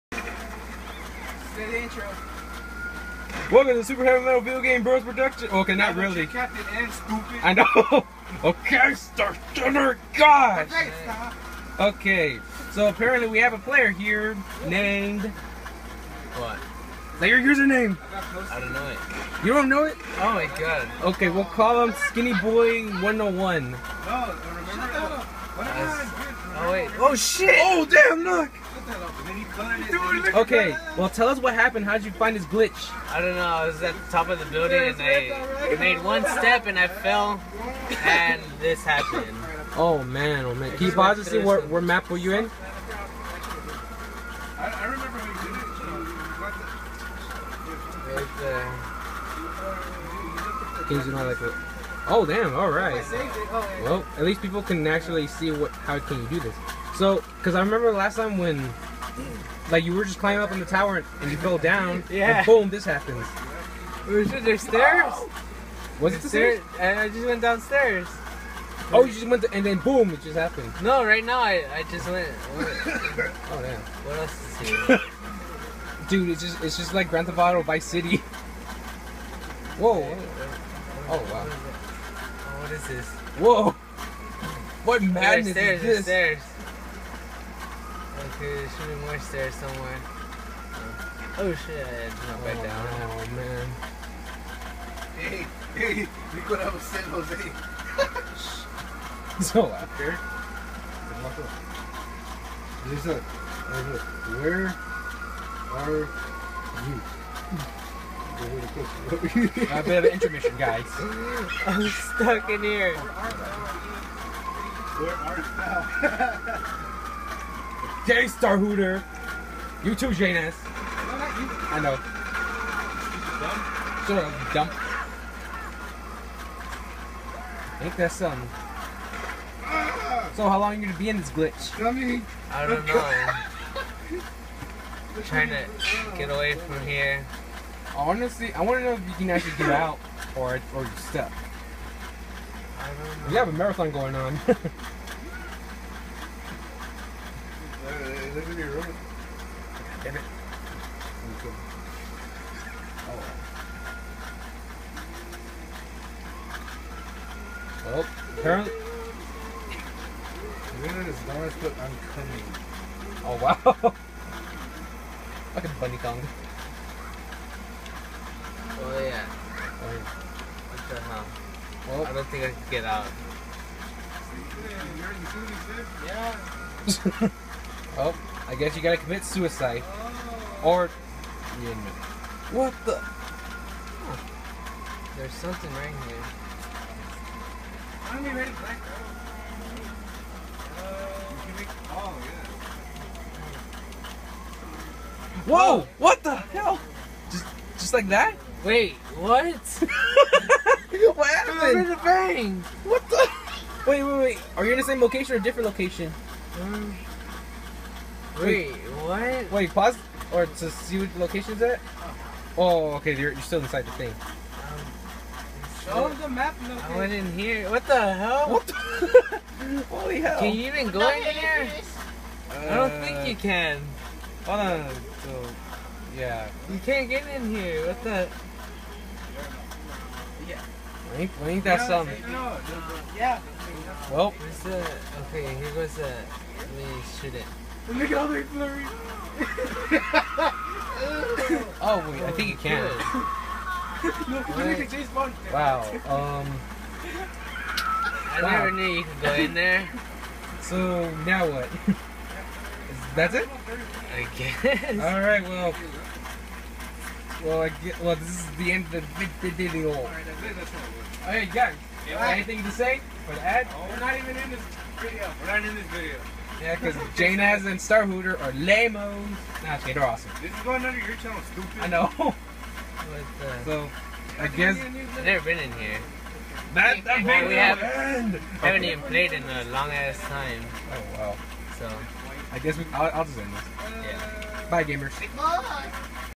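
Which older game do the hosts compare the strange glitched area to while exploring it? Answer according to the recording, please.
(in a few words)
Grand Theft Auto Vice City.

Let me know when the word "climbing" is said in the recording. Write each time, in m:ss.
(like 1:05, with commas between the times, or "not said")
1:00.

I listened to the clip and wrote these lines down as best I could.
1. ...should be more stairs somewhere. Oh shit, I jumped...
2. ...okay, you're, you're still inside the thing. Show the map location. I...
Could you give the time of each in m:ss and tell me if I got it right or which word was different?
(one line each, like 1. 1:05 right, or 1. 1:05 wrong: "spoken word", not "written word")
1. 1:28 right
2. 3:33 right.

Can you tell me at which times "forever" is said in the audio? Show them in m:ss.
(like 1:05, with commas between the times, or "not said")
not said.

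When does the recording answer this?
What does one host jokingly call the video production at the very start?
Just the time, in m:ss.
0:03.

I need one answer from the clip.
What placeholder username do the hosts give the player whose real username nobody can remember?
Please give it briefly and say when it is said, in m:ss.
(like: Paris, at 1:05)
Skinny Boy 101, at 0:22.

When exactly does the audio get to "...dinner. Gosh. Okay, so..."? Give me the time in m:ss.
0:09.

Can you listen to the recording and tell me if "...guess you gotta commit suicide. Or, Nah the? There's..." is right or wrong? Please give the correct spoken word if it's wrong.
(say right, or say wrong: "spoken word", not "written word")
wrong: "What", not "Nah".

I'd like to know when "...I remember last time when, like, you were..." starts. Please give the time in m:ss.
0:57.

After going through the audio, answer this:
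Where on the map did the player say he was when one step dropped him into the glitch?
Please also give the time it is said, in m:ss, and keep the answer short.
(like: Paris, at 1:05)
the top of the building, at 0:34.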